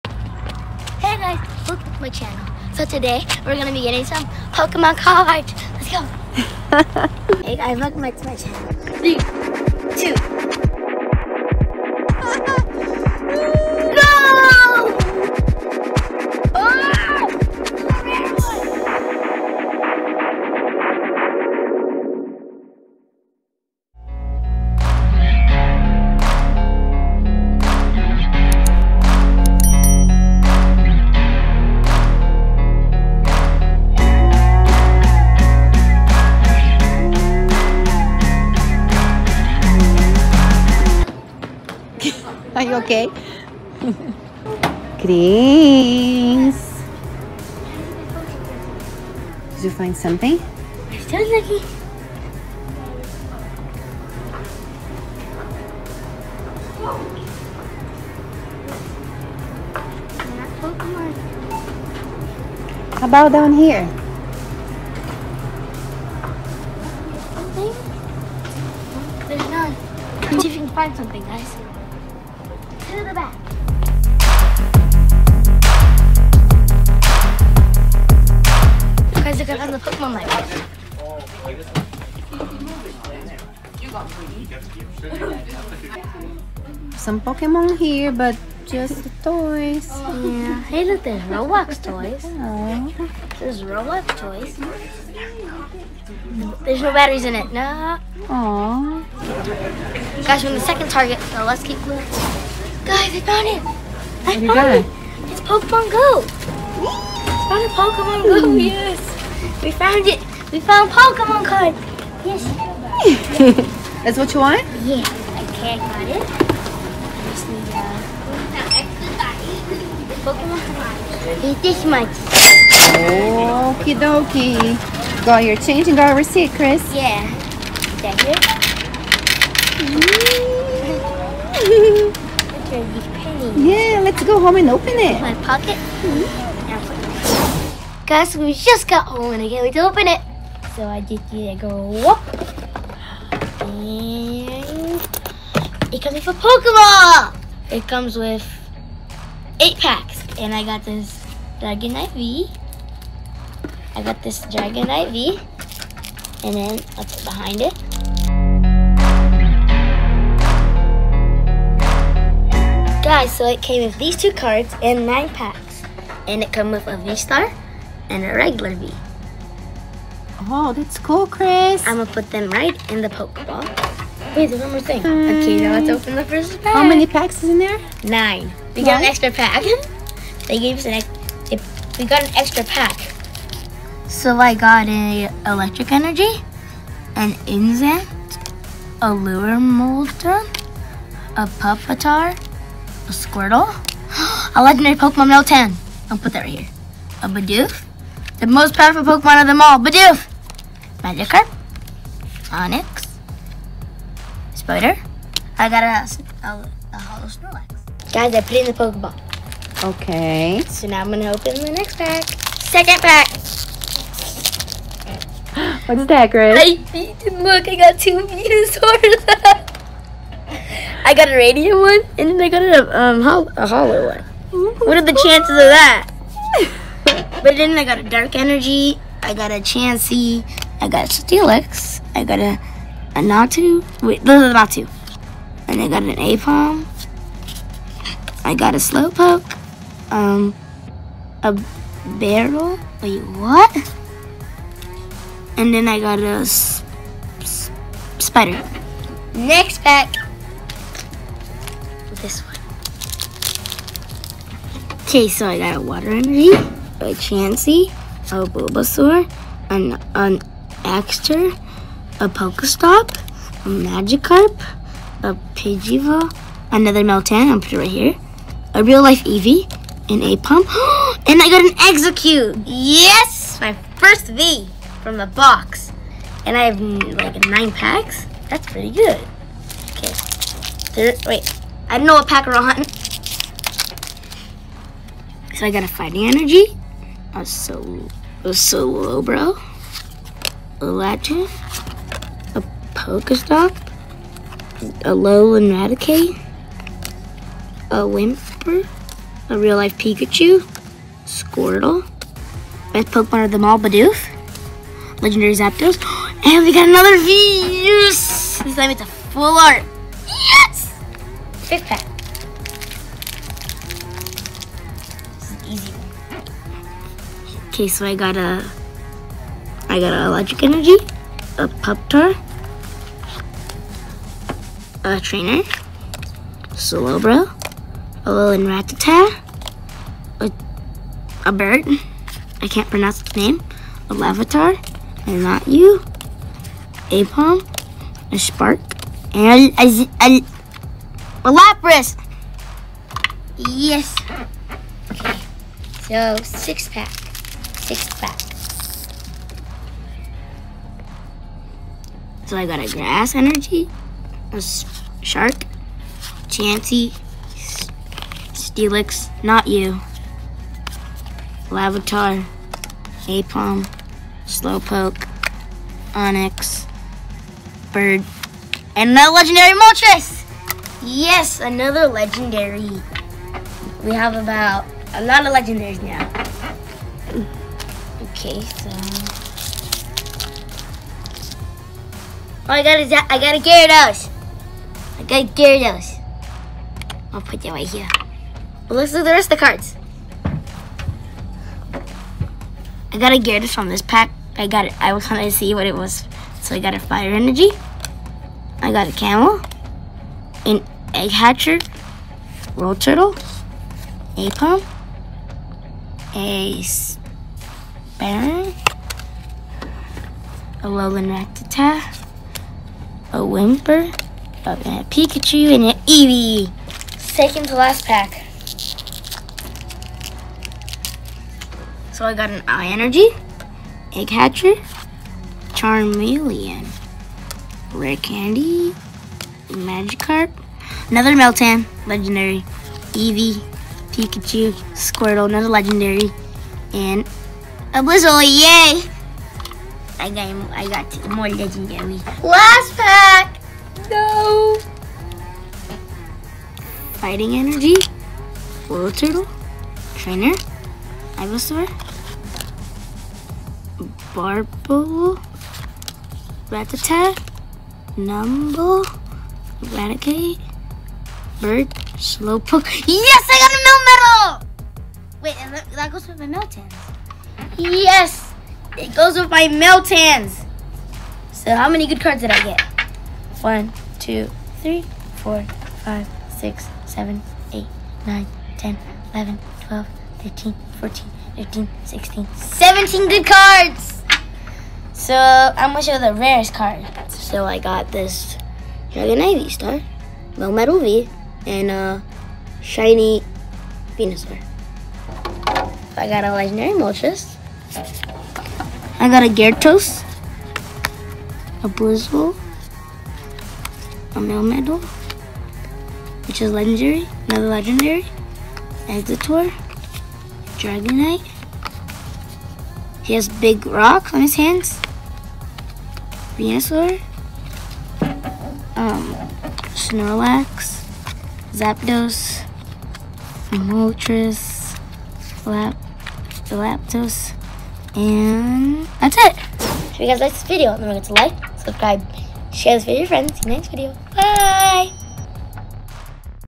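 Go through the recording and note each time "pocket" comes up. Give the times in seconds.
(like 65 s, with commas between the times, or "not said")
135 s.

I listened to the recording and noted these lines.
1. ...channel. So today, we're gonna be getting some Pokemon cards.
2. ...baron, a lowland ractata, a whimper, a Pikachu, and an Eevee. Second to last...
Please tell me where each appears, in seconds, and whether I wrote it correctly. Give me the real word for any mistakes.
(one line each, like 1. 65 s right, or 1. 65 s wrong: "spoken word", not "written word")
1. 2 s right
2. 408 s right.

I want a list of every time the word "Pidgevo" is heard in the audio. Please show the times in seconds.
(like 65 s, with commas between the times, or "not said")
265 s.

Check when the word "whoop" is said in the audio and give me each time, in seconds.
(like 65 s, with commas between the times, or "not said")
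141 s.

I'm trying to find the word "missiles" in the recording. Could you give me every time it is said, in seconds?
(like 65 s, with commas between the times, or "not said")
not said.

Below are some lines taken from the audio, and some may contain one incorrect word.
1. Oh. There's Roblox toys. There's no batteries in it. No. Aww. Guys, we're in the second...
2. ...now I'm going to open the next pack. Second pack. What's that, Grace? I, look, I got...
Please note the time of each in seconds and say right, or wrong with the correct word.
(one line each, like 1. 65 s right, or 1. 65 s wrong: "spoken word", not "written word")
1. 92 s right
2. 210 s right.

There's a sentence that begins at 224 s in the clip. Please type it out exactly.
What are the chances of that?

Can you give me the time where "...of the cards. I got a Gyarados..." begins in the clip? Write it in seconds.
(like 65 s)
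389 s.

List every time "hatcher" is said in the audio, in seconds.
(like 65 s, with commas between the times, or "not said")
401 s, 424 s.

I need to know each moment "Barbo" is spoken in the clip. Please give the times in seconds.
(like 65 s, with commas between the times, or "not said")
454 s.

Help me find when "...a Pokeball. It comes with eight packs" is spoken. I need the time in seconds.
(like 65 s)
146 s.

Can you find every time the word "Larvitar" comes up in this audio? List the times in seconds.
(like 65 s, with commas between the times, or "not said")
334 s, 361 s.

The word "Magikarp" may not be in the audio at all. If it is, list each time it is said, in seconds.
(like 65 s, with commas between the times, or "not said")
201 s, 263 s, 429 s.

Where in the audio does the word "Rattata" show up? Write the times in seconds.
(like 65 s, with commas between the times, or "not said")
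328 s, 456 s.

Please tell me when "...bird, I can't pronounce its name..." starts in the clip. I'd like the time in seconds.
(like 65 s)
331 s.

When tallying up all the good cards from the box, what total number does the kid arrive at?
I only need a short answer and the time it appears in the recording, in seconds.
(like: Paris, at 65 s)
17, at 482 s.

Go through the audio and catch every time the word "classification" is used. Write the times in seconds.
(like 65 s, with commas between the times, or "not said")
not said.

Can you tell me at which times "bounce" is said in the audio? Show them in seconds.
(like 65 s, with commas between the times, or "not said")
not said.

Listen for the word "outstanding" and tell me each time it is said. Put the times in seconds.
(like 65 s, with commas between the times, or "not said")
not said.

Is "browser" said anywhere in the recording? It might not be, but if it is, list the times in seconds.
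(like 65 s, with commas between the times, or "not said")
not said.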